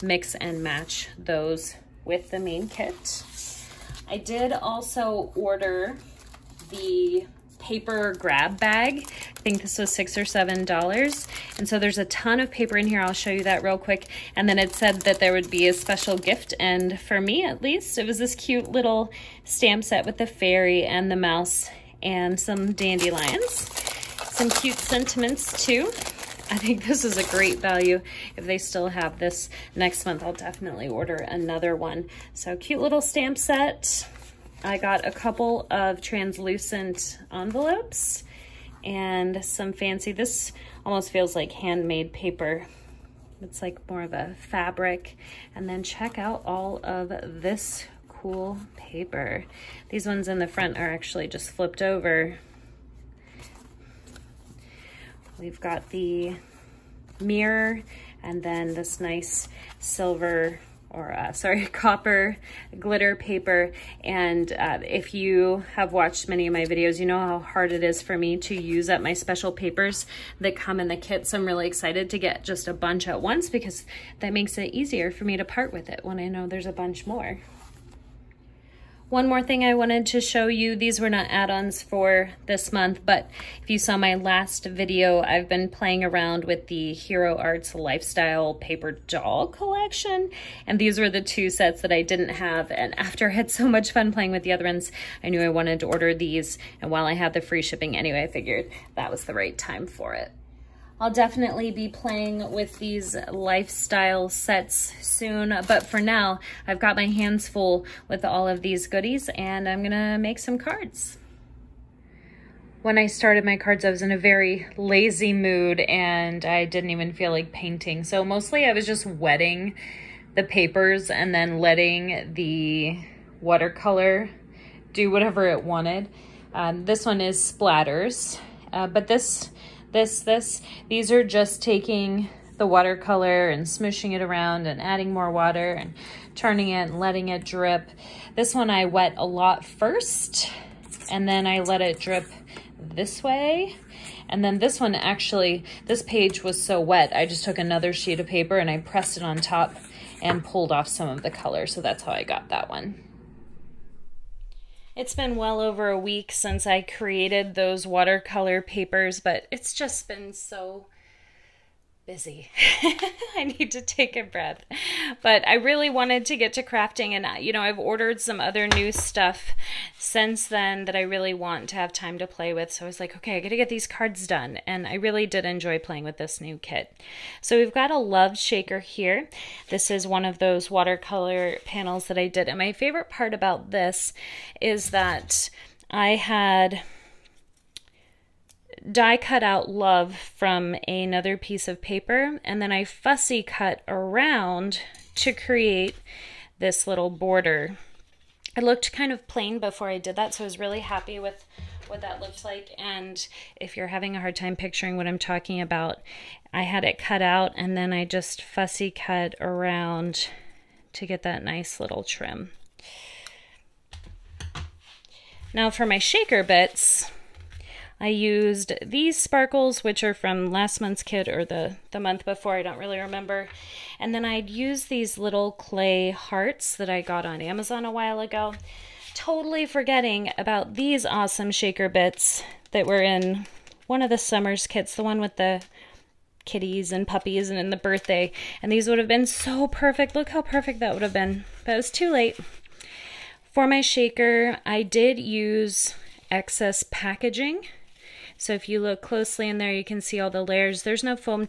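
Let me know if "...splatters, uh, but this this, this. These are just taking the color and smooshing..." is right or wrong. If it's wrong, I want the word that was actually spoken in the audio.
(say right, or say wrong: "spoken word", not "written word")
wrong: "watercolor", not "color".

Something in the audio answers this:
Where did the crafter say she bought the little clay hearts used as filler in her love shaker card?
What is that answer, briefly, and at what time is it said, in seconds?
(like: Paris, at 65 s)
Amazon, at 227 s.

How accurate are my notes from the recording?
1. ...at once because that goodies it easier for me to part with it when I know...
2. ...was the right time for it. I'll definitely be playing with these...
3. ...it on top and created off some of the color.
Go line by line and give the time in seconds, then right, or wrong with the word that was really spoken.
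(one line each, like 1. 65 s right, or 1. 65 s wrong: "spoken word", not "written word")
1. 73 s wrong: "makes", not "goodies"
2. 99 s right
3. 149 s wrong: "pulled", not "created".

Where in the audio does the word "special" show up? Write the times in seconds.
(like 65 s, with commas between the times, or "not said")
15 s, 69 s.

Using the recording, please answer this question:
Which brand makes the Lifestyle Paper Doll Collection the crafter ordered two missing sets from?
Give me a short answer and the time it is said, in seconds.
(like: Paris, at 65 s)
Hero Arts, at 86 s.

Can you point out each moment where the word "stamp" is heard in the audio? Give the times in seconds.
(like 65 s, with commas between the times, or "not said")
19 s, 33 s.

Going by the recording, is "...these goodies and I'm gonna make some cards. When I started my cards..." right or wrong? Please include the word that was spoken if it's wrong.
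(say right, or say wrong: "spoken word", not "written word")
right.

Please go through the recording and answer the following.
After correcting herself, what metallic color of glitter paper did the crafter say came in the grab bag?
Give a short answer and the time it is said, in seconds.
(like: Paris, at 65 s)
copper, at 61 s.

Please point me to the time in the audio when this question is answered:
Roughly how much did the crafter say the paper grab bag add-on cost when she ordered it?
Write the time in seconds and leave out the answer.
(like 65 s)
9 s.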